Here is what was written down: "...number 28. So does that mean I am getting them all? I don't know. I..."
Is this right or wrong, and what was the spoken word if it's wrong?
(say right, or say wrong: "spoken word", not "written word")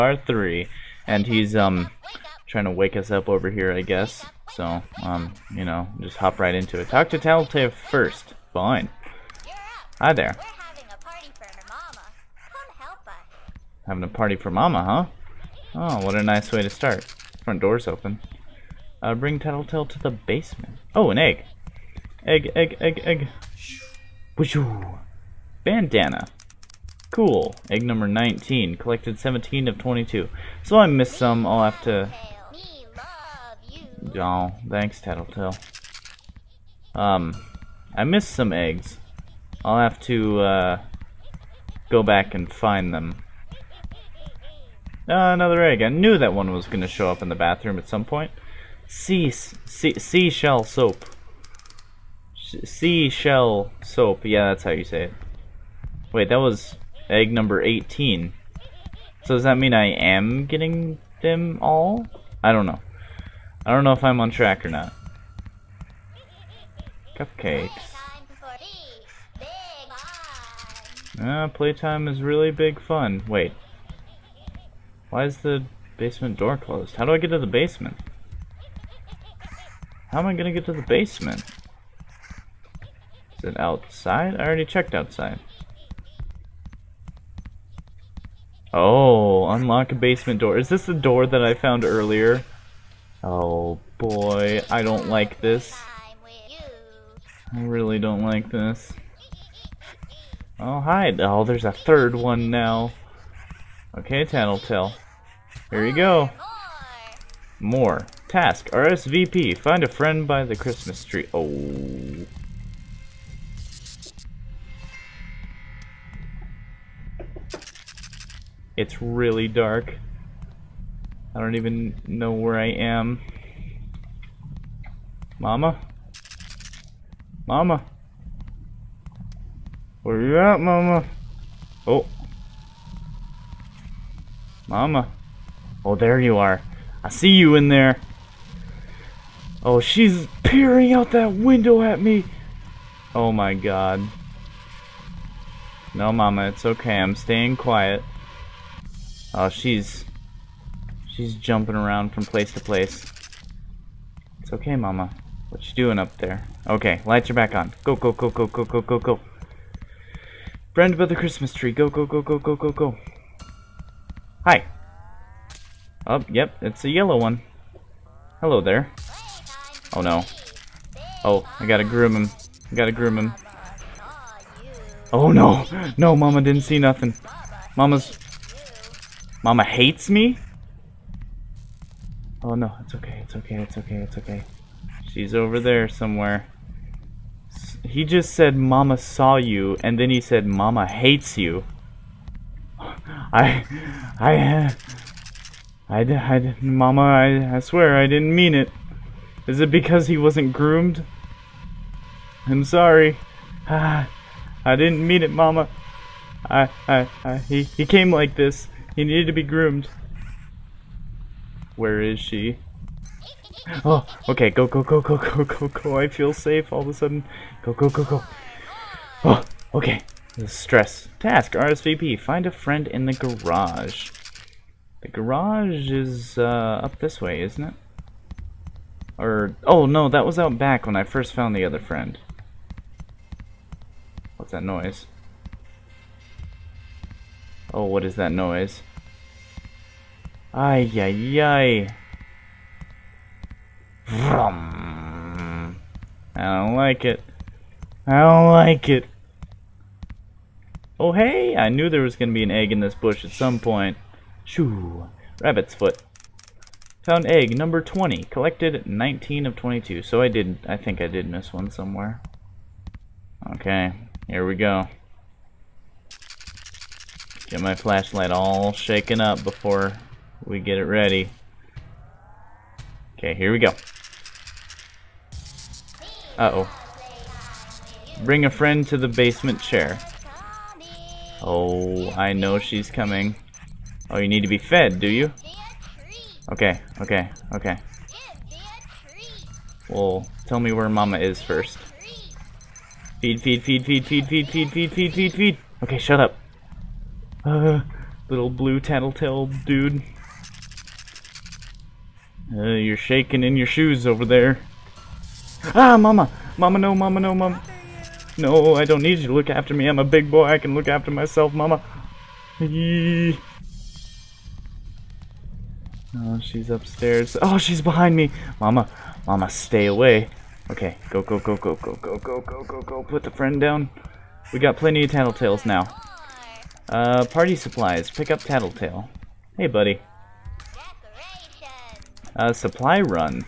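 wrong: "18", not "28".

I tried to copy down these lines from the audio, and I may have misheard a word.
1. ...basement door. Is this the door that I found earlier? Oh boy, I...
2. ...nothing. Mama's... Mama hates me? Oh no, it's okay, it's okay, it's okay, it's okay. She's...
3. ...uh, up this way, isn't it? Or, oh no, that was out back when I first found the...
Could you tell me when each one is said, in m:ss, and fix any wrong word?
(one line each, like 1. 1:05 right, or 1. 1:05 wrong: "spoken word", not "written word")
1. 1:29 right
2. 2:56 right
3. 3:46 right.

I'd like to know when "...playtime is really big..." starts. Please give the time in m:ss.
1:11.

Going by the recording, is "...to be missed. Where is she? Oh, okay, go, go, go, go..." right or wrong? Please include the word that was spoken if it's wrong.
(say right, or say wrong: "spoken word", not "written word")
wrong: "groomed", not "missed".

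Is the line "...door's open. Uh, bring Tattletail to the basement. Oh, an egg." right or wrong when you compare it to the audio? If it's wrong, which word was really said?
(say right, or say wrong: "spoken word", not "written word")
right.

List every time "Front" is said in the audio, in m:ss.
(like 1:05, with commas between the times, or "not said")
0:17.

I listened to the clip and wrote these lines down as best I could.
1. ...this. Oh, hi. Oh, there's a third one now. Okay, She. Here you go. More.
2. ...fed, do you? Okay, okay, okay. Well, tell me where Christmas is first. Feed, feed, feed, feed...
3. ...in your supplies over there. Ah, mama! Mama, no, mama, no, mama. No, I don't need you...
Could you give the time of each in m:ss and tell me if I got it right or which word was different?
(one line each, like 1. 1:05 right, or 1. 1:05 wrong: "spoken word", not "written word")
1. 1:38 wrong: "Tattletail", not "She"
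2. 4:44 wrong: "Mama", not "Christmas"
3. 5:03 wrong: "shoes", not "supplies".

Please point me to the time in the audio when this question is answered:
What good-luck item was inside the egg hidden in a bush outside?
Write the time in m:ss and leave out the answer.
4:15.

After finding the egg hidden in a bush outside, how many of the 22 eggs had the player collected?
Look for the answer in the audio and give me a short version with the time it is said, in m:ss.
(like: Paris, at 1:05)
19, at 4:18.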